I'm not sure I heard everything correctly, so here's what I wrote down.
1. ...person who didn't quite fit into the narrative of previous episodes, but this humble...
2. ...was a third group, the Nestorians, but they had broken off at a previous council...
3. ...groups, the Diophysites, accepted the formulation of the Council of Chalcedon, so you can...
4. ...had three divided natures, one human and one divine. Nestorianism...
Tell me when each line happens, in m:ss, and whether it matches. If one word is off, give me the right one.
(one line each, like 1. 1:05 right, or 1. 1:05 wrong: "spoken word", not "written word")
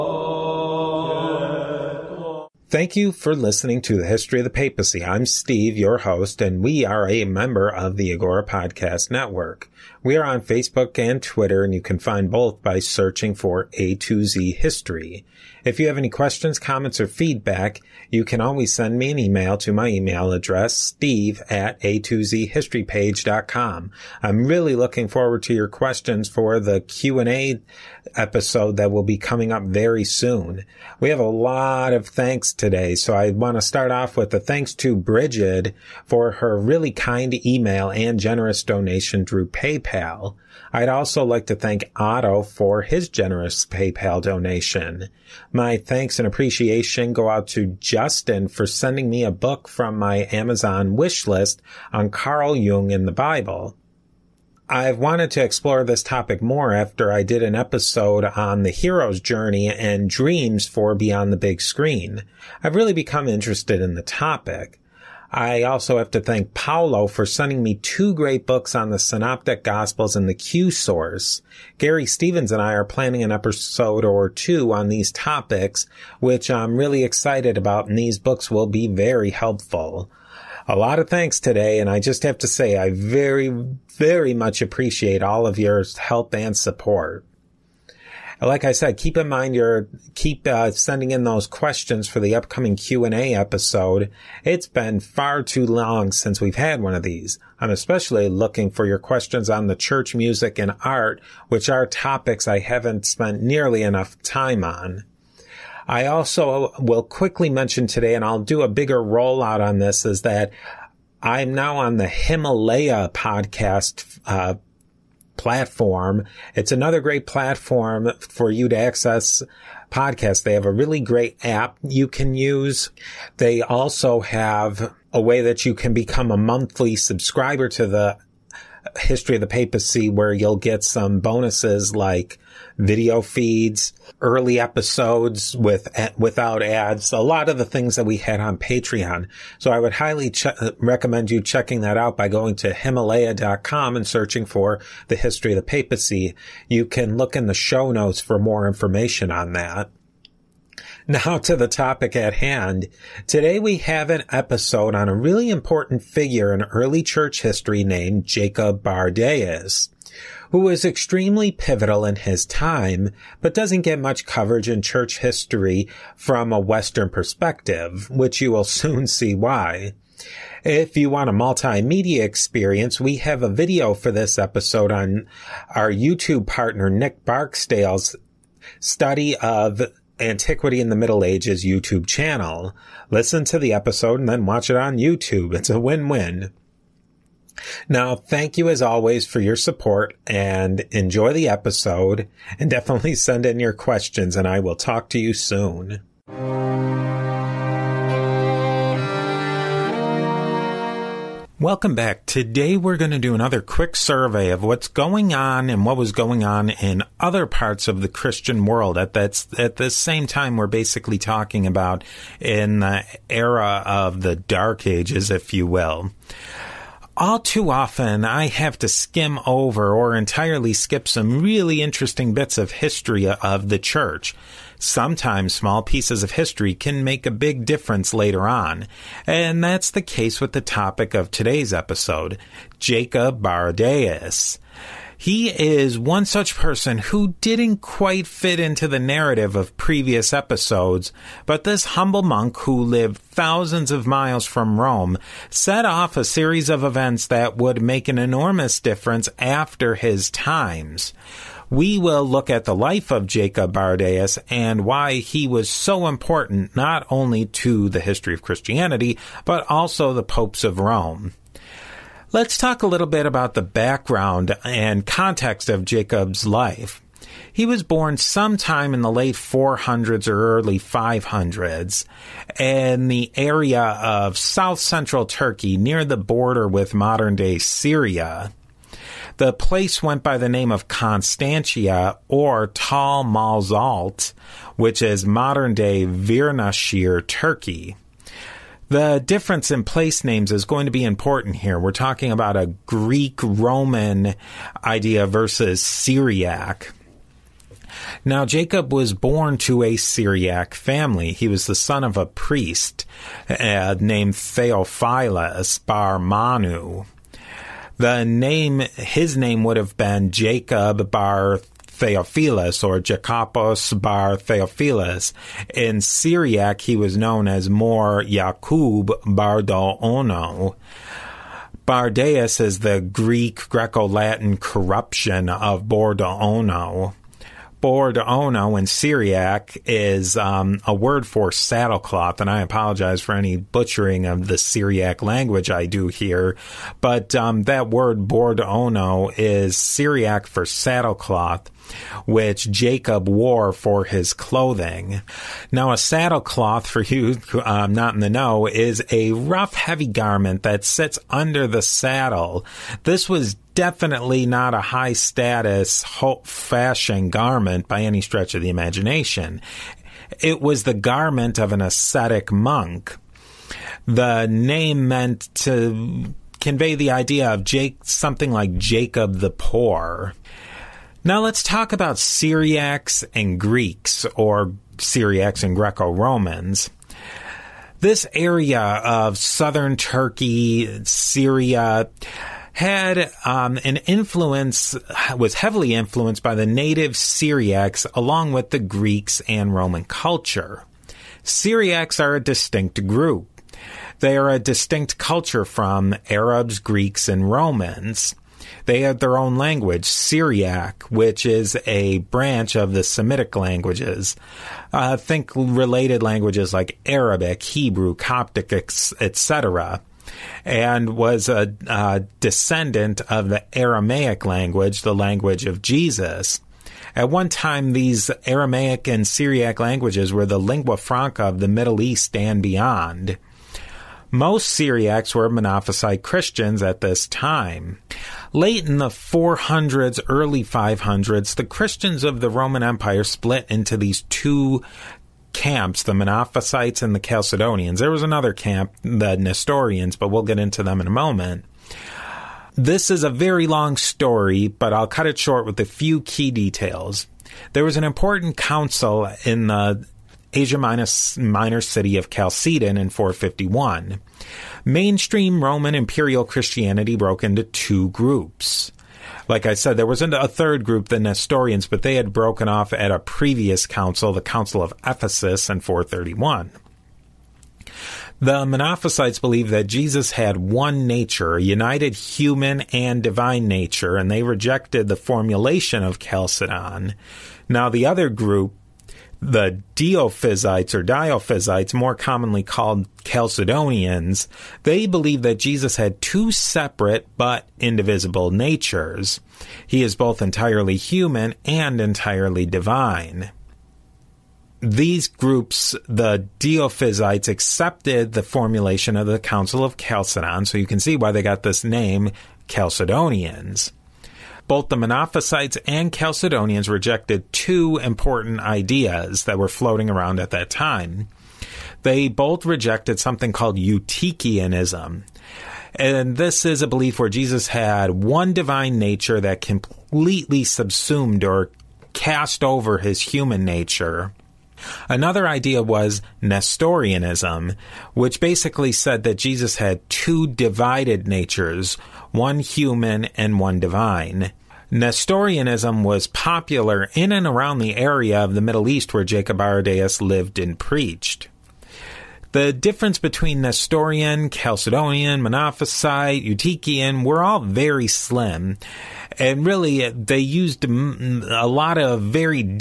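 1. 3:56 right
2. 7:40 right
3. 8:15 right
4. 8:49 wrong: "two", not "three".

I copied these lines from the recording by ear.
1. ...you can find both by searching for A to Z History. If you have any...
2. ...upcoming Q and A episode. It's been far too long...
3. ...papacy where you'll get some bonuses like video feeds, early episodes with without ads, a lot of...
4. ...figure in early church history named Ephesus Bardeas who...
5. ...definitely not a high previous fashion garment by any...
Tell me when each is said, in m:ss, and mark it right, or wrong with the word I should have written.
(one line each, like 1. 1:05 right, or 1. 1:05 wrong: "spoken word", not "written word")
1. 0:11 right
2. 1:32 right
3. 2:09 right
4. 2:36 wrong: "Jacob", not "Ephesus"
5. 5:53 wrong: "status", not "previous".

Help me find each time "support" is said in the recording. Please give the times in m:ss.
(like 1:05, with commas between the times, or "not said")
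1:26, 3:09.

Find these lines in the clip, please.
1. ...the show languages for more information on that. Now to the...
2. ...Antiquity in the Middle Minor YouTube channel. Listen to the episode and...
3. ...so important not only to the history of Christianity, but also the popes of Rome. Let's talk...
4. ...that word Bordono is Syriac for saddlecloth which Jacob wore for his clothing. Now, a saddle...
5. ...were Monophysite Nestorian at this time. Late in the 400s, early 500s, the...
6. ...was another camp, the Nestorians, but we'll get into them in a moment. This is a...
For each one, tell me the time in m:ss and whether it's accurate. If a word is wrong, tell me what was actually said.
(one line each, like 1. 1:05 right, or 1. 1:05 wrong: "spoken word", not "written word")
1. 2:27 wrong: "notes", not "languages"
2. 3:00 wrong: "Ages", not "Minor"
3. 4:15 right
4. 5:37 right
5. 7:05 wrong: "Christians", not "Nestorian"
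6. 7:18 right.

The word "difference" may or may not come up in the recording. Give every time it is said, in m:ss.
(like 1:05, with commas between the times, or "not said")
3:47, 4:08, 4:49, 9:02.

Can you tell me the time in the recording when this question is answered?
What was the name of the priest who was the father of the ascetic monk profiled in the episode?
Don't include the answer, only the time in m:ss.
5:04.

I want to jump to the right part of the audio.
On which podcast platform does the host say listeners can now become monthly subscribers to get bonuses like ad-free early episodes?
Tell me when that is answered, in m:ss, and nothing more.
1:52.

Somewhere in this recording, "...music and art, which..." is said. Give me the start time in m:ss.
1:40.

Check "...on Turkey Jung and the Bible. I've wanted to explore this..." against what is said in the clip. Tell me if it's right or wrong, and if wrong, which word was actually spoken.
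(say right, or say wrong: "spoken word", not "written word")
wrong: "Carl", not "Turkey".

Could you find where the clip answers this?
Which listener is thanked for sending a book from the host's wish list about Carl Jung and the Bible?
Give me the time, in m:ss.
0:47.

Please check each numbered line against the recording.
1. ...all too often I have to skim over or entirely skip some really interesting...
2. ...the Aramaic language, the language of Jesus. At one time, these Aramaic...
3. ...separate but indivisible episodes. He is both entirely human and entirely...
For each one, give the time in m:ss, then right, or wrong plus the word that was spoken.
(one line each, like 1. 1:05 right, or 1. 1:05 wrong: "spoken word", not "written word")
1. 3:37 right
2. 6:53 right
3. 8:06 wrong: "natures", not "episodes".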